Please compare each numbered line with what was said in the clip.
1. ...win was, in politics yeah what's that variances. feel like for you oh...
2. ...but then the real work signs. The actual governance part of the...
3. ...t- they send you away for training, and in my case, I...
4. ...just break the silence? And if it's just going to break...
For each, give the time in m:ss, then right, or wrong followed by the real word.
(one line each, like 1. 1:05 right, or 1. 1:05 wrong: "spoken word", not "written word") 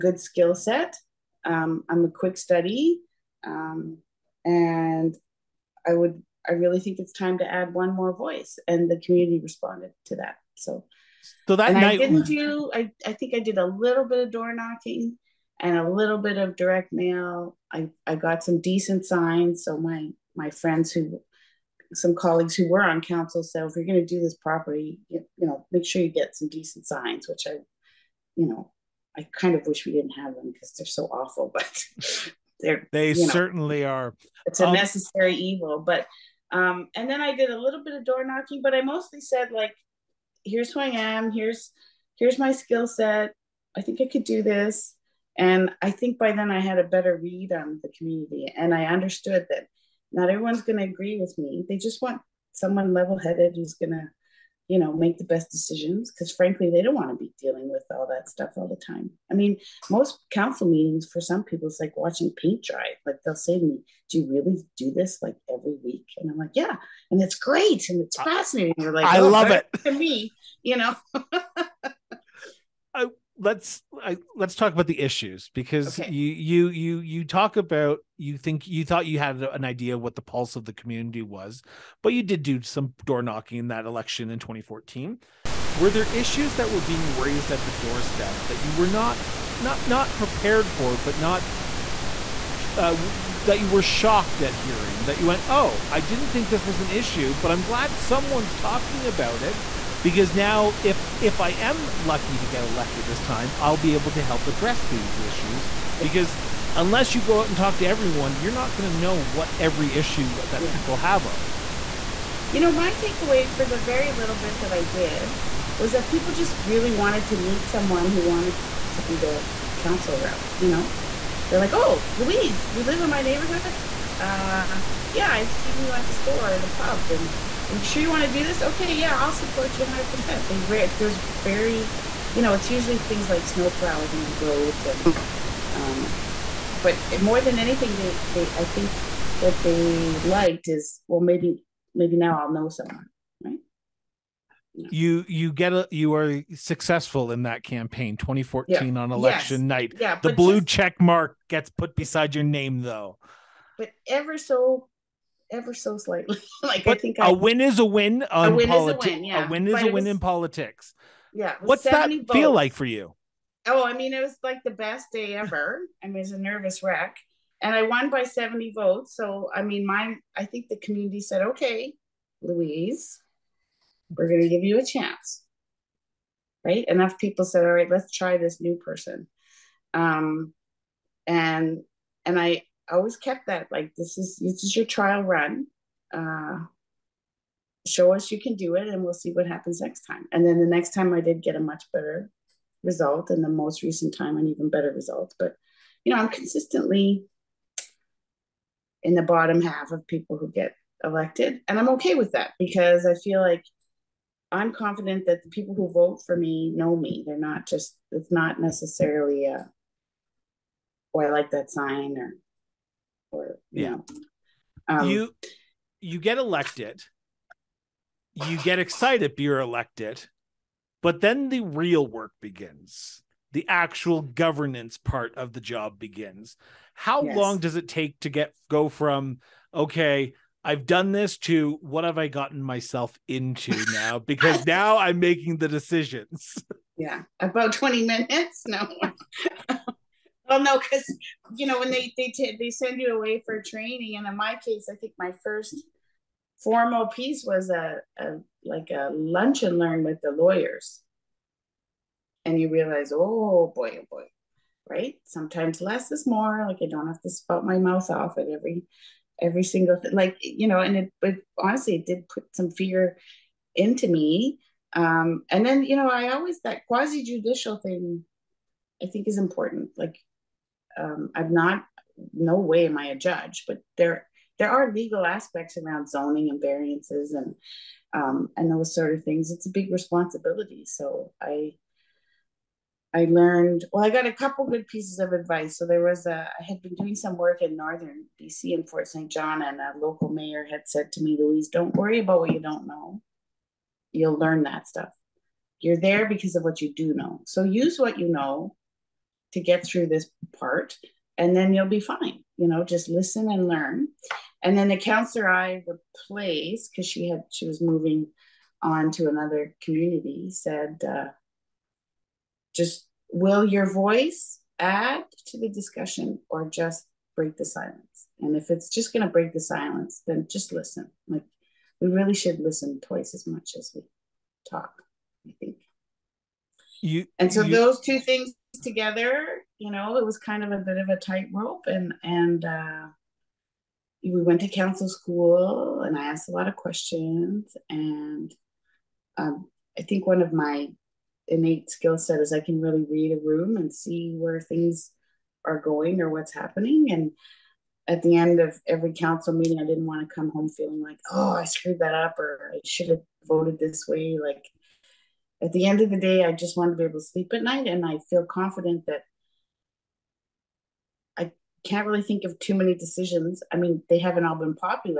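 1. 2:39 wrong: "votes", not "variances"
2. 3:41 wrong: "begins", not "signs"
3. 4:02 right
4. 5:16 right.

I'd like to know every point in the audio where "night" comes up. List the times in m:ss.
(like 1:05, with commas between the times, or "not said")
0:11, 2:29, 5:57.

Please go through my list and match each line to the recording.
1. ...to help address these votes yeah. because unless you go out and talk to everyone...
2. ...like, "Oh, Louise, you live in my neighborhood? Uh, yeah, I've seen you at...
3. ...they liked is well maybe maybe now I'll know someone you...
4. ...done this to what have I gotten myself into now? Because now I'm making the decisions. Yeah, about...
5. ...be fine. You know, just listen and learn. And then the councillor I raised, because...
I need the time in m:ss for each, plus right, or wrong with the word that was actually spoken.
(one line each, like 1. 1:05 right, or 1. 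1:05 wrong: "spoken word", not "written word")
1. 1:44 wrong: "issues", not "votes"
2. 2:01 right
3. 2:19 right
4. 3:50 right
5. 5:01 wrong: "replaced", not "raised".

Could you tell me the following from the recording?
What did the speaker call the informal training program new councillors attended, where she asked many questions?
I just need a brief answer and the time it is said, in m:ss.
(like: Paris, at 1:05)
Council school, at 5:34.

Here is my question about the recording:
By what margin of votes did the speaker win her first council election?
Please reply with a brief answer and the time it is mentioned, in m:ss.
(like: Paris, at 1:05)
70 votes, at 2:48.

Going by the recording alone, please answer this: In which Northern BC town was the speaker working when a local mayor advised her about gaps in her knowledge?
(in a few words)
Fort St. John.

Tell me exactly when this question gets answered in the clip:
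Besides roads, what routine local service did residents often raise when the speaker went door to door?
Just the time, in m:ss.
2:13.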